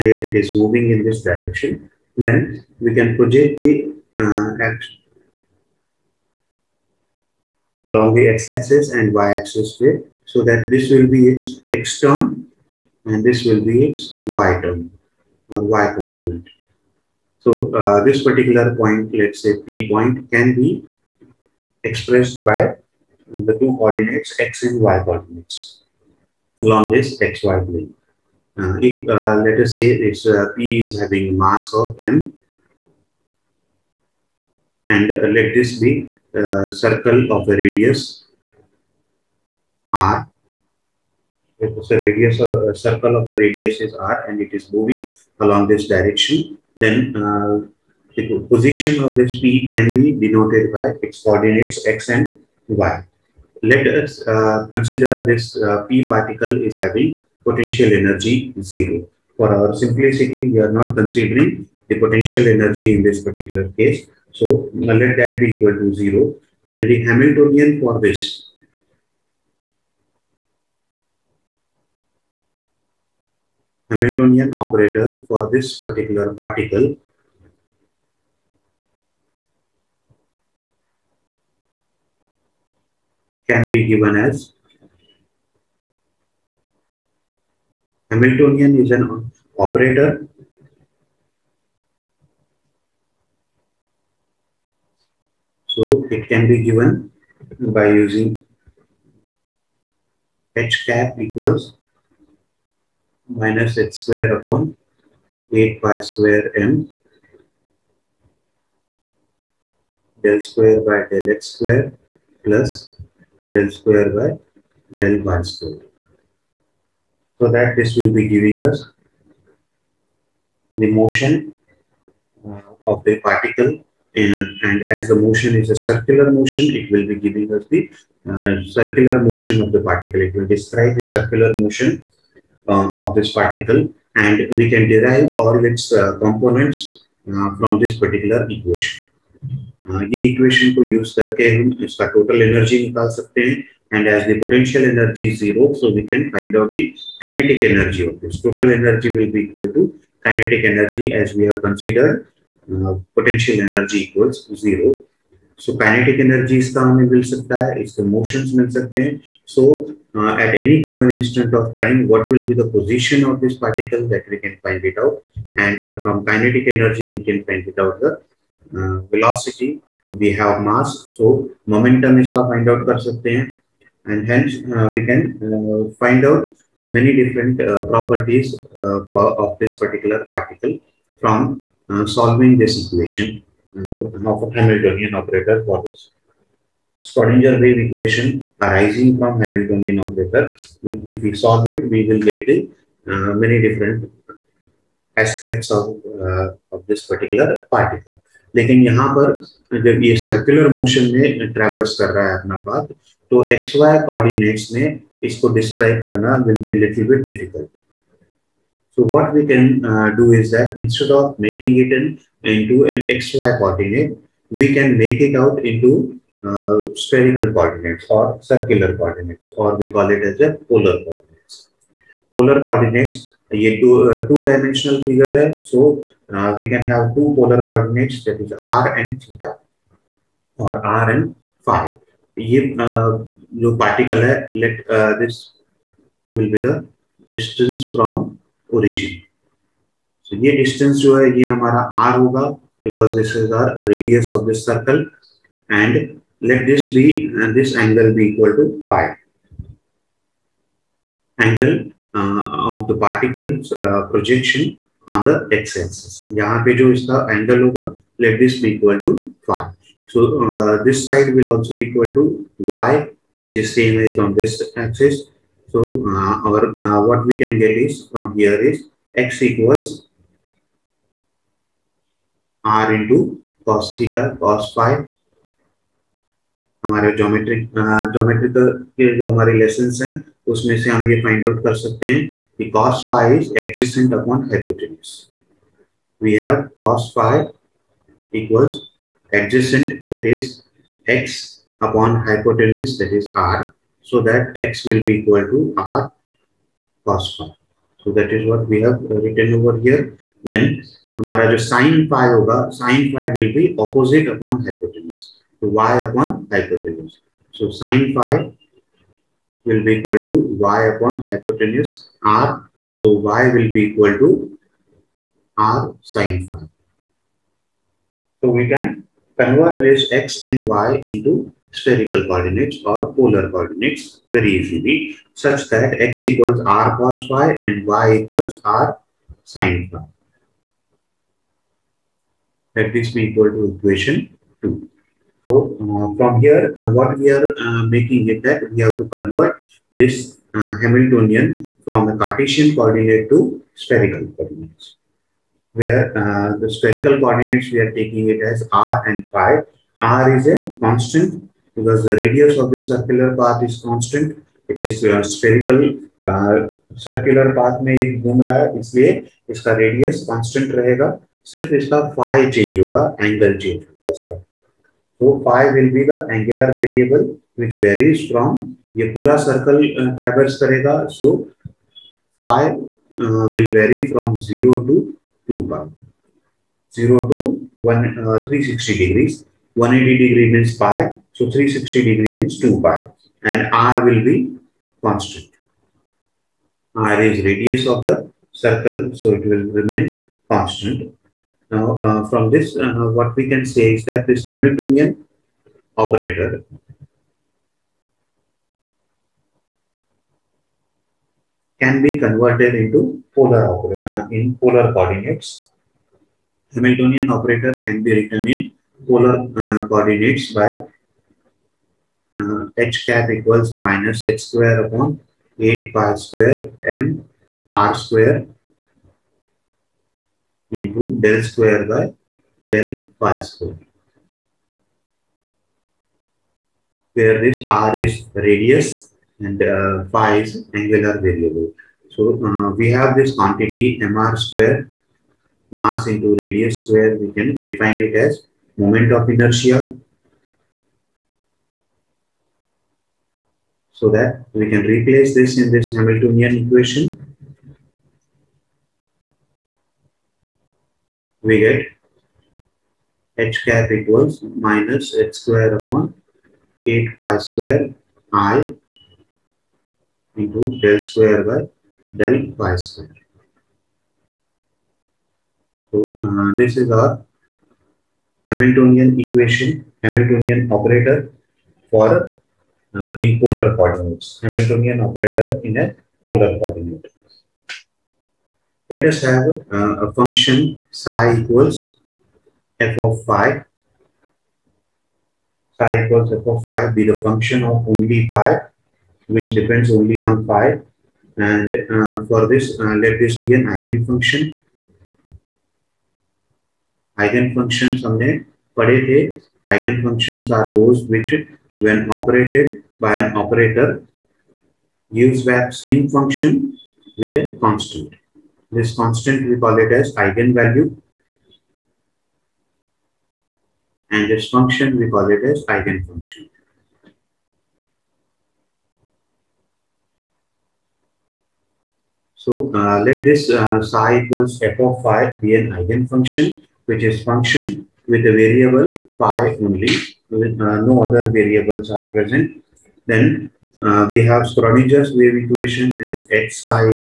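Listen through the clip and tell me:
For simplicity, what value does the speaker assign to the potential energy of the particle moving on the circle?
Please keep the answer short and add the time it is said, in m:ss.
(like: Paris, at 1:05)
0, at 0:56.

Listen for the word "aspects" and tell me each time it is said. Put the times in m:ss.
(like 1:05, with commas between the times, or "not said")
3:15.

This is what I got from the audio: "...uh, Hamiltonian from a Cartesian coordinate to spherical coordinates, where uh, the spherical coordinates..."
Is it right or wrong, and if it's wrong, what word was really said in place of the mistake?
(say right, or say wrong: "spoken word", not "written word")
right.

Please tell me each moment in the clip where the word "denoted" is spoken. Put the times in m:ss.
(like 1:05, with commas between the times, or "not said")
0:50.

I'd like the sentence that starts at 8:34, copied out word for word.
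And this function we call it as eigenfunction.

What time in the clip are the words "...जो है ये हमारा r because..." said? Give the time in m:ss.
4:00.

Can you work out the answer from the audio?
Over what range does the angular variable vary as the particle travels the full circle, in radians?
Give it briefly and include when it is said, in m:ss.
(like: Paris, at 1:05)
0 to 2 pi, at 6:14.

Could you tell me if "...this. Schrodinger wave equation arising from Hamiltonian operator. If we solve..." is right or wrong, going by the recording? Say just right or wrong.
right.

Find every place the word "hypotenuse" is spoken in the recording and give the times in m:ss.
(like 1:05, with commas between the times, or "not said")
4:44, 4:52, 5:06, 5:11.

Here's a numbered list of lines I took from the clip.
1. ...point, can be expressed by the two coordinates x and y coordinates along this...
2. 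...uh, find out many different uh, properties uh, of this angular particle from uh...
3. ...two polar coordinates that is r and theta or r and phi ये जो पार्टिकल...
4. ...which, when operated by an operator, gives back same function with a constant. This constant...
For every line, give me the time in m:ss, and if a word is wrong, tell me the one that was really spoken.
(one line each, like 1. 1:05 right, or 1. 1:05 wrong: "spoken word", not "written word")
1. 0:19 right
2. 2:55 wrong: "particular", not "angular"
3. 3:47 right
4. 8:21 right.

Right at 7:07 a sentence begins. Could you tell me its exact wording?
Where this r is radius and uh, phi is angular variable.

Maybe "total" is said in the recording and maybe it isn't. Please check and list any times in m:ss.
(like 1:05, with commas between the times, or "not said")
2:22, 2:28.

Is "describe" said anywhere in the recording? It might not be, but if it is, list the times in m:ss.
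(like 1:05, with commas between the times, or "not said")
2:10.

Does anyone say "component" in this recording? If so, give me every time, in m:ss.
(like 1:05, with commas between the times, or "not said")
0:15, 2:16.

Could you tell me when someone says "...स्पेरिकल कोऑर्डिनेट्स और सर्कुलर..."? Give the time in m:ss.
3:37.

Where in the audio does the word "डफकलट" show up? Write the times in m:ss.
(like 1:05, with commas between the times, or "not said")
3:27.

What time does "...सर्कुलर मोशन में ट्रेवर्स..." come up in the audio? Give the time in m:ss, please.
3:20.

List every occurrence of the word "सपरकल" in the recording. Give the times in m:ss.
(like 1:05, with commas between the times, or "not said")
3:37.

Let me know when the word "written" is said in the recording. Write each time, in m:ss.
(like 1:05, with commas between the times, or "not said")
4:59, 6:48.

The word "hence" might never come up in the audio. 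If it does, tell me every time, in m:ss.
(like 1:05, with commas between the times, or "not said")
2:54.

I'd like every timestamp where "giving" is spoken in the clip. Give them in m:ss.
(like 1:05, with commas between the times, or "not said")
1:58, 2:07.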